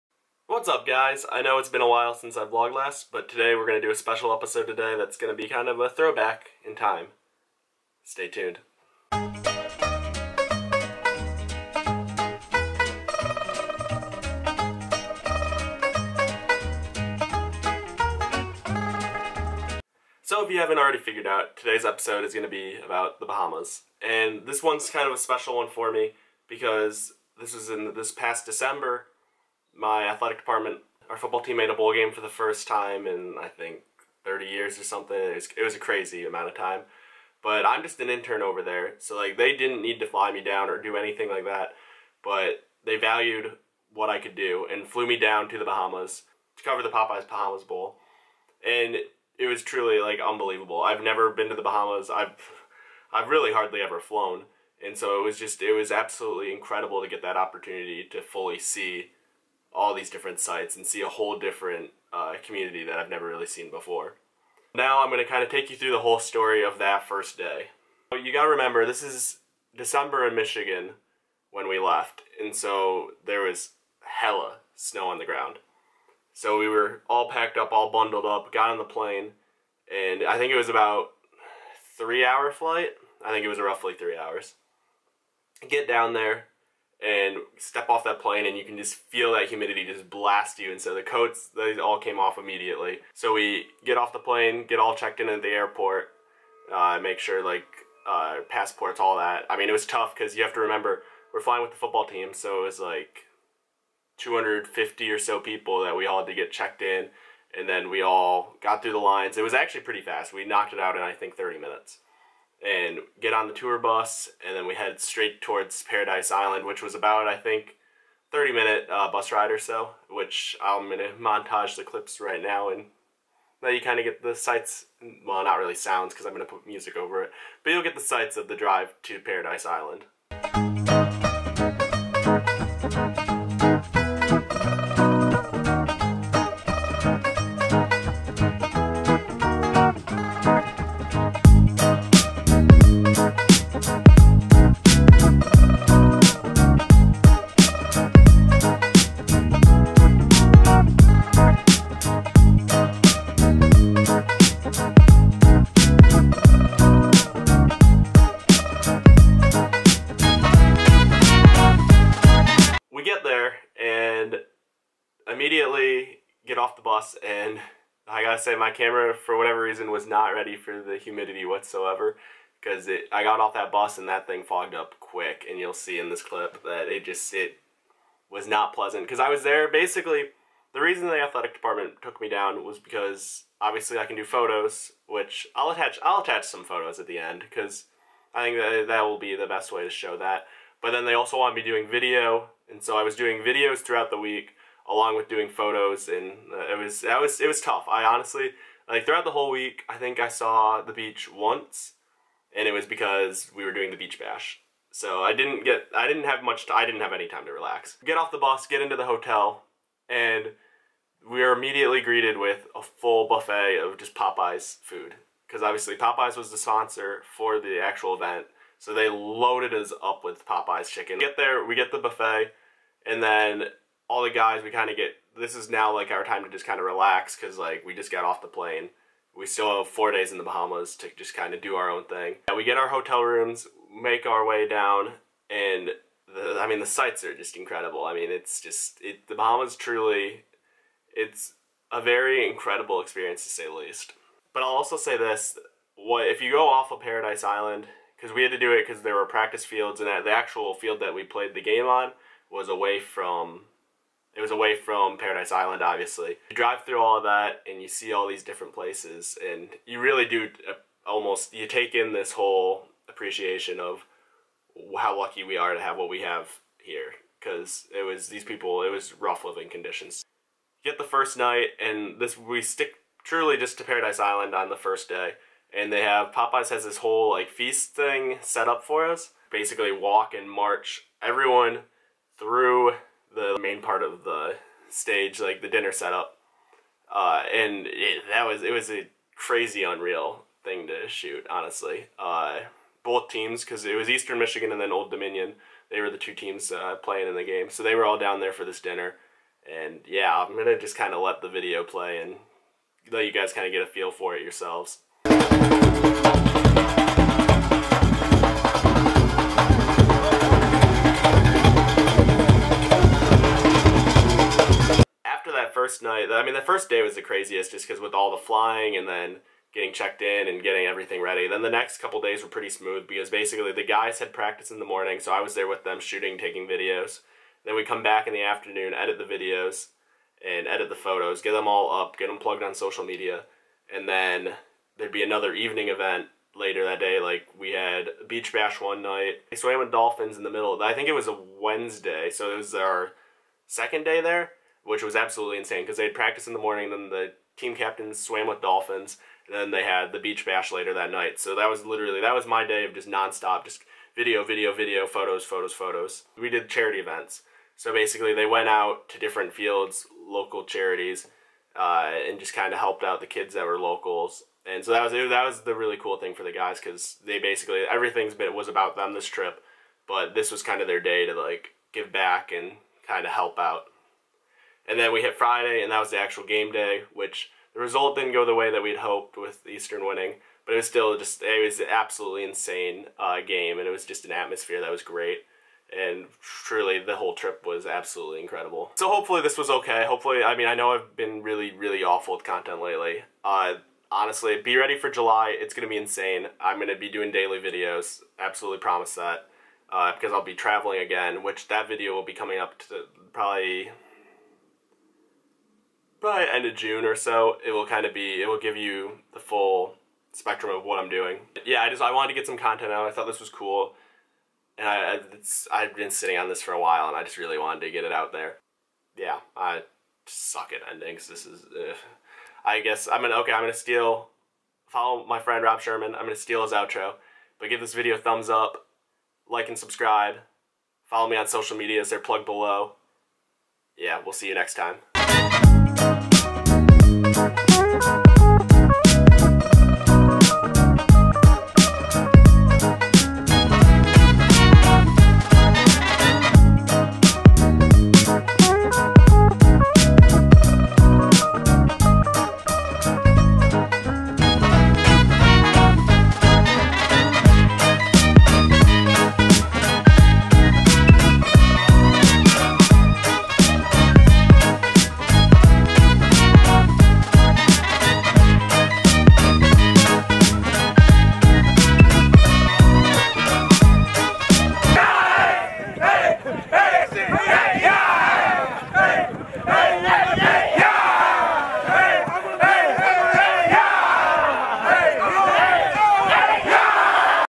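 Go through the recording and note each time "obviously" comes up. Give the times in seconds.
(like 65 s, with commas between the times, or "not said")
183 s, 215 s, 255 s.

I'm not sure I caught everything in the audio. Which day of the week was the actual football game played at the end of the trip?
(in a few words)
Friday.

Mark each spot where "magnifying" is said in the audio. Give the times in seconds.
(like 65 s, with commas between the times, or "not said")
not said.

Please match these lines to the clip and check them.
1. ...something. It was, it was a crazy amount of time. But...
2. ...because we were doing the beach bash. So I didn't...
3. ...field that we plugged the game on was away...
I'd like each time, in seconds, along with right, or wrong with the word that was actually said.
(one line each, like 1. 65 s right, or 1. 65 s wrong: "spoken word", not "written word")
1. 34 s right
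2. 202 s right
3. 250 s wrong: "played", not "plugged".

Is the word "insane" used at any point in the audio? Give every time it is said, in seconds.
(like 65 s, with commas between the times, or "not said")
345 s, 382 s, 395 s.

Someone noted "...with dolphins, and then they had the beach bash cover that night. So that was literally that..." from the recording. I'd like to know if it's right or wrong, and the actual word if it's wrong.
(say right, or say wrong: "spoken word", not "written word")
wrong: "later", not "cover".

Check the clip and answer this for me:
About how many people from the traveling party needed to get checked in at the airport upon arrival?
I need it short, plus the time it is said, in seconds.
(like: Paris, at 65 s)
250, at 104 s.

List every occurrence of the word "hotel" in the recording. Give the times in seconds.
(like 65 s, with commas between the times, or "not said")
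209 s, 232 s.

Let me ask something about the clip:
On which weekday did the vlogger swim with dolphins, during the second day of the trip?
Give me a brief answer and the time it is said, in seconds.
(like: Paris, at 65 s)
Wednesday, at 341 s.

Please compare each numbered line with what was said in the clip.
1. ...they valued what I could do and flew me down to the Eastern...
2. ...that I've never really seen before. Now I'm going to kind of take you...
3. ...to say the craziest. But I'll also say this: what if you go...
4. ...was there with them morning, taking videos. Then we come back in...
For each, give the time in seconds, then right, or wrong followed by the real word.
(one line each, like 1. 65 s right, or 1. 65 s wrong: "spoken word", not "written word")
1. 42 s wrong: "Bahamas", not "Eastern"
2. 62 s right
3. 243 s wrong: "least", not "craziest"
4. 325 s wrong: "shooting", not "morning".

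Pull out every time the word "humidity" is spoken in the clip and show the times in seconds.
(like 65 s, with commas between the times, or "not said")
89 s, 170 s.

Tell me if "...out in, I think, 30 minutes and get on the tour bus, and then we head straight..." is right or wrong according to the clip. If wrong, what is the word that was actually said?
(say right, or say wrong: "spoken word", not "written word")
right.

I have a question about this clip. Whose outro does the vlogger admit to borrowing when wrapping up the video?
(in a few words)
Rob Sherman.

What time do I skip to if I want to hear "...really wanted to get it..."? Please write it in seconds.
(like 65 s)
417 s.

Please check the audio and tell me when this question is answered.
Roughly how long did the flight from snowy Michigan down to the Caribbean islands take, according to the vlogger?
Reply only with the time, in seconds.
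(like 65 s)
81 s.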